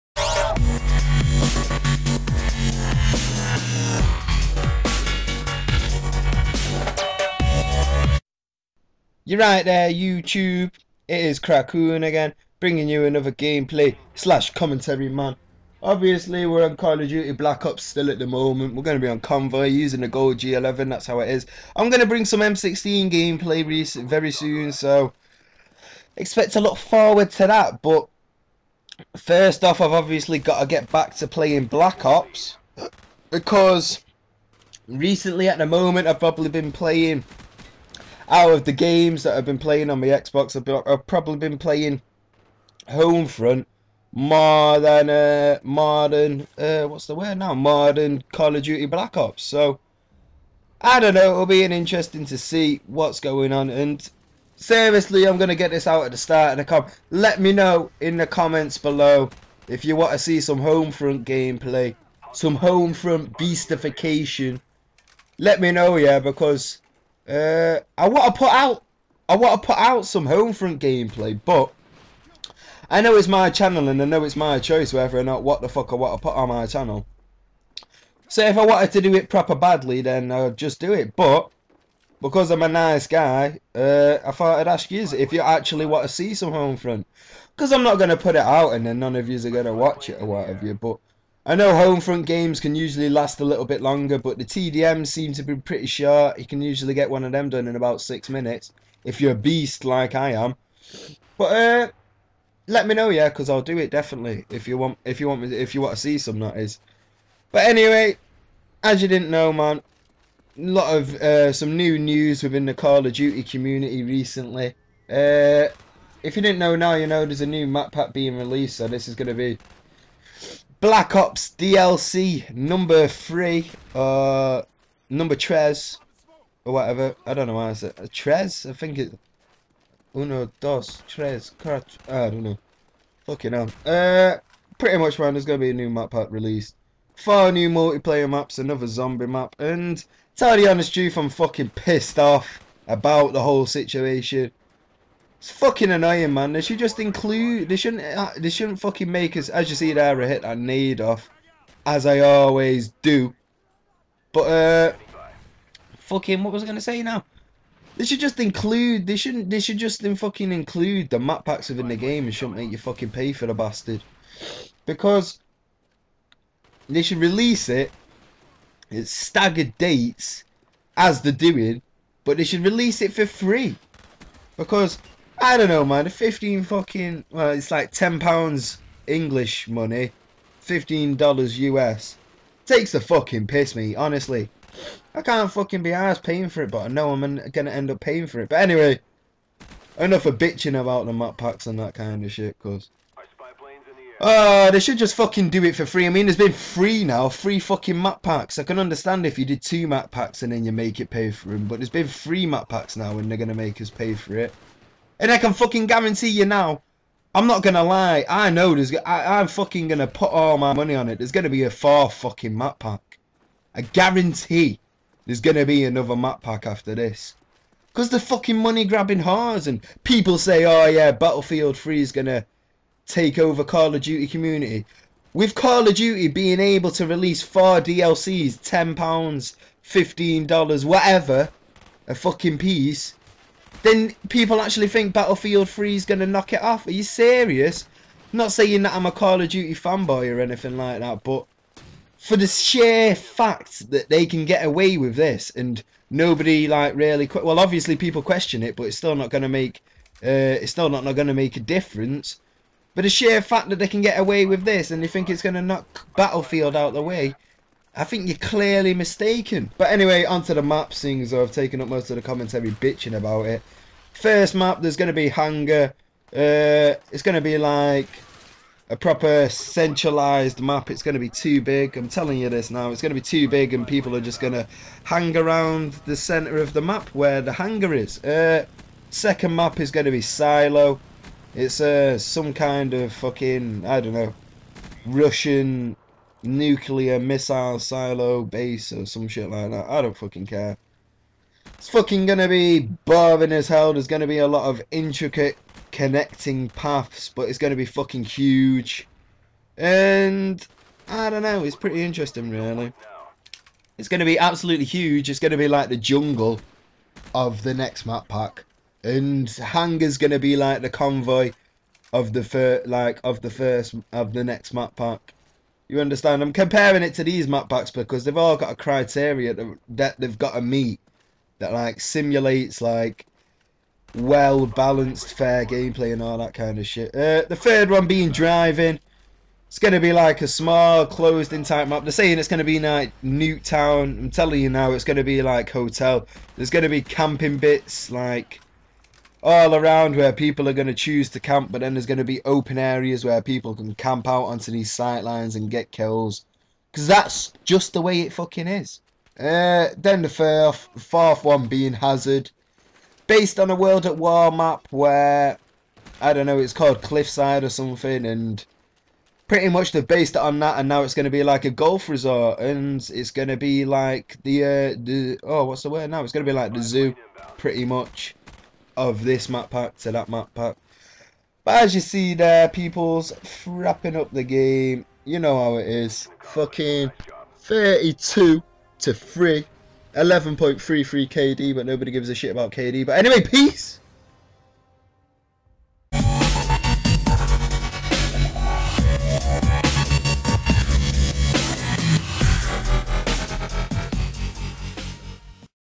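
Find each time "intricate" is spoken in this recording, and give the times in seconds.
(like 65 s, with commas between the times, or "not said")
294 s.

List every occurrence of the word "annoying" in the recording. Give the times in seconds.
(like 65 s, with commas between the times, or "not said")
145 s.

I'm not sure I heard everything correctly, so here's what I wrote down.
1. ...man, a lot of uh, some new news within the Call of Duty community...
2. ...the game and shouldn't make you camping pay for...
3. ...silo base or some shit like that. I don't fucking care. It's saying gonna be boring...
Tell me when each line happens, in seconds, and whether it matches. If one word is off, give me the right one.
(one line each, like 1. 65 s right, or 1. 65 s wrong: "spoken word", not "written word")
1. 109 s right
2. 161 s wrong: "fucking", not "camping"
3. 287 s wrong: "fucking", not "saying".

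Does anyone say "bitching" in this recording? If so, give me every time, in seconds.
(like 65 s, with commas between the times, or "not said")
190 s, 262 s.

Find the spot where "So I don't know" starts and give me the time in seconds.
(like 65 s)
49 s.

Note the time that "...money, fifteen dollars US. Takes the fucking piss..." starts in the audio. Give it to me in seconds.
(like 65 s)
179 s.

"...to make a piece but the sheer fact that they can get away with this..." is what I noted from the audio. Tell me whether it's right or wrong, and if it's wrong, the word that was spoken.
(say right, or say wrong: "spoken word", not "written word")
wrong: "difference", not "piece".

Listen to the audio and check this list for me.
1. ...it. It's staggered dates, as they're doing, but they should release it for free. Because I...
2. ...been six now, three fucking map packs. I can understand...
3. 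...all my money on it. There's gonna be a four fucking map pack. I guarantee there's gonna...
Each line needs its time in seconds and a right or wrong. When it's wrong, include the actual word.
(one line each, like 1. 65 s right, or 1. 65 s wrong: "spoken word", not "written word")
1. 167 s right
2. 196 s wrong: "three", not "six"
3. 210 s right.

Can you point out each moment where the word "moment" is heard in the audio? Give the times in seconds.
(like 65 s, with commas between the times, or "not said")
18 s, 35 s.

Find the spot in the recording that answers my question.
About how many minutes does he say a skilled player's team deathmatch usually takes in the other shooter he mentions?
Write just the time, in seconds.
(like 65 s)
97 s.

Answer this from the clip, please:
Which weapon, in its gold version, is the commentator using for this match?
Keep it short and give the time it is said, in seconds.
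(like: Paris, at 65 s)
G11, at 20 s.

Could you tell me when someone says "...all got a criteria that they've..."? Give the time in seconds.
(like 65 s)
318 s.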